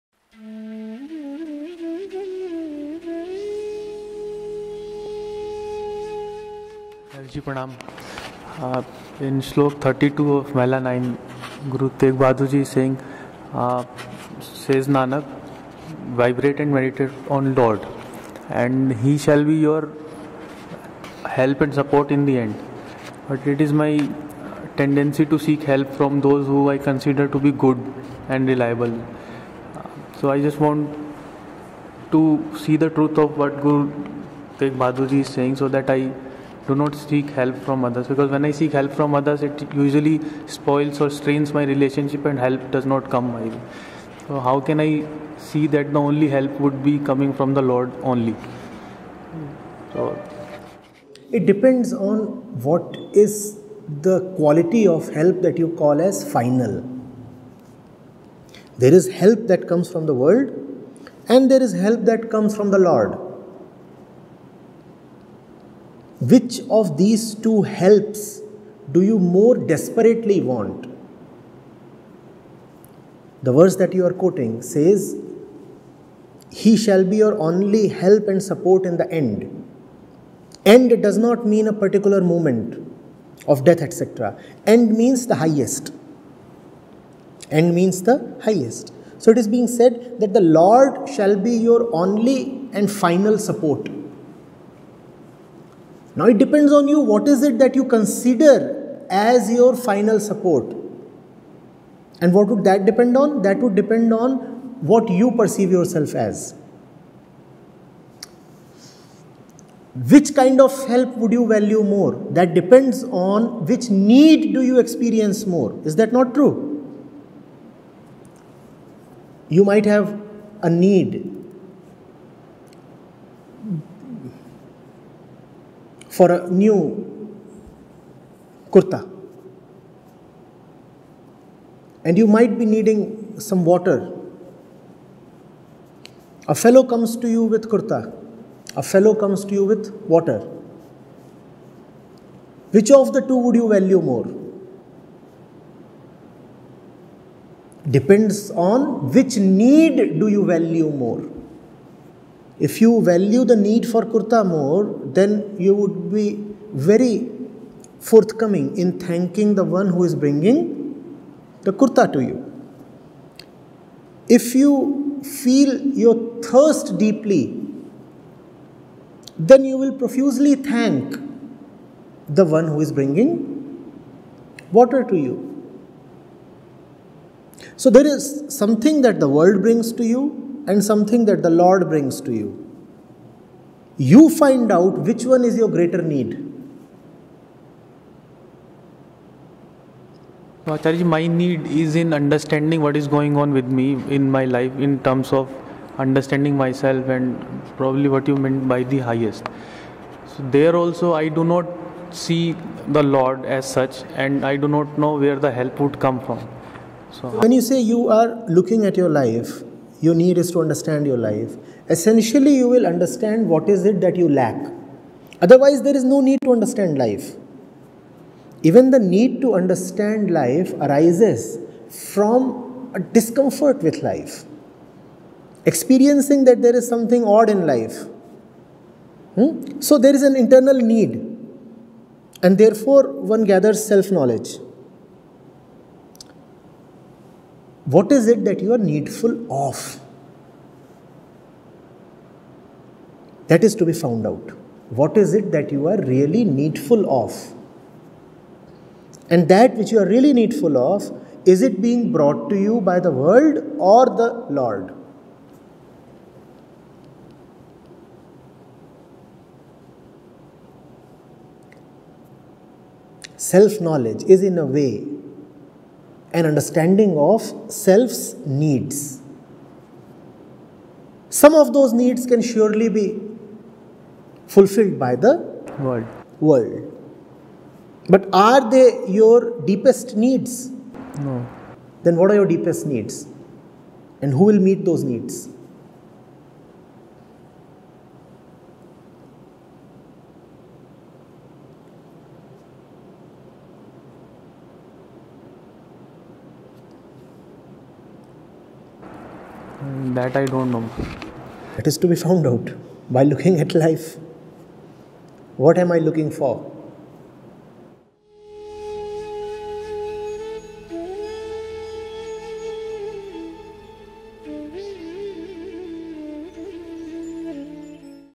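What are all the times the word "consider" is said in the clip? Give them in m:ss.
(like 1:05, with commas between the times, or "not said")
0:26, 1:37.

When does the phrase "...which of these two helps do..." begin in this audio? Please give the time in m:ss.
1:06.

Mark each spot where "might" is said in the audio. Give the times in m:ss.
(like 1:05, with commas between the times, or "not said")
1:59, 2:12.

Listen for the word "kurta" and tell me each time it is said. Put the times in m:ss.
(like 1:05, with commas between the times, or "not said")
2:08, 2:17, 2:34, 2:41.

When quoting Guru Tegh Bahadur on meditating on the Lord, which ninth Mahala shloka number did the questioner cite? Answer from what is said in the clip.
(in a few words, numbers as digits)
32.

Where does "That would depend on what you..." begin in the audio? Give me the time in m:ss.
1:43.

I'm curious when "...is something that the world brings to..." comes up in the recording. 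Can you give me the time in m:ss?
2:58.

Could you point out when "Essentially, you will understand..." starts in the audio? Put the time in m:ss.
3:31.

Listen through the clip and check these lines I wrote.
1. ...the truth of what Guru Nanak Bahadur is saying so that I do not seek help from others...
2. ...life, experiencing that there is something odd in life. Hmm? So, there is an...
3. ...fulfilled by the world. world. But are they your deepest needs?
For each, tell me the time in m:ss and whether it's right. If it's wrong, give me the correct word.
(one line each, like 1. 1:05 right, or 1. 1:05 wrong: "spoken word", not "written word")
1. 0:32 wrong: "Tegh", not "Nanak"
2. 3:44 right
3. 4:34 right.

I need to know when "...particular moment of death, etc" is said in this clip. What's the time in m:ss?
1:21.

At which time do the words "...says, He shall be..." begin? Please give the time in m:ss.
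1:14.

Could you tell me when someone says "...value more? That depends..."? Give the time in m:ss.
1:51.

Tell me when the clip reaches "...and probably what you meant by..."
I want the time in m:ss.
3:17.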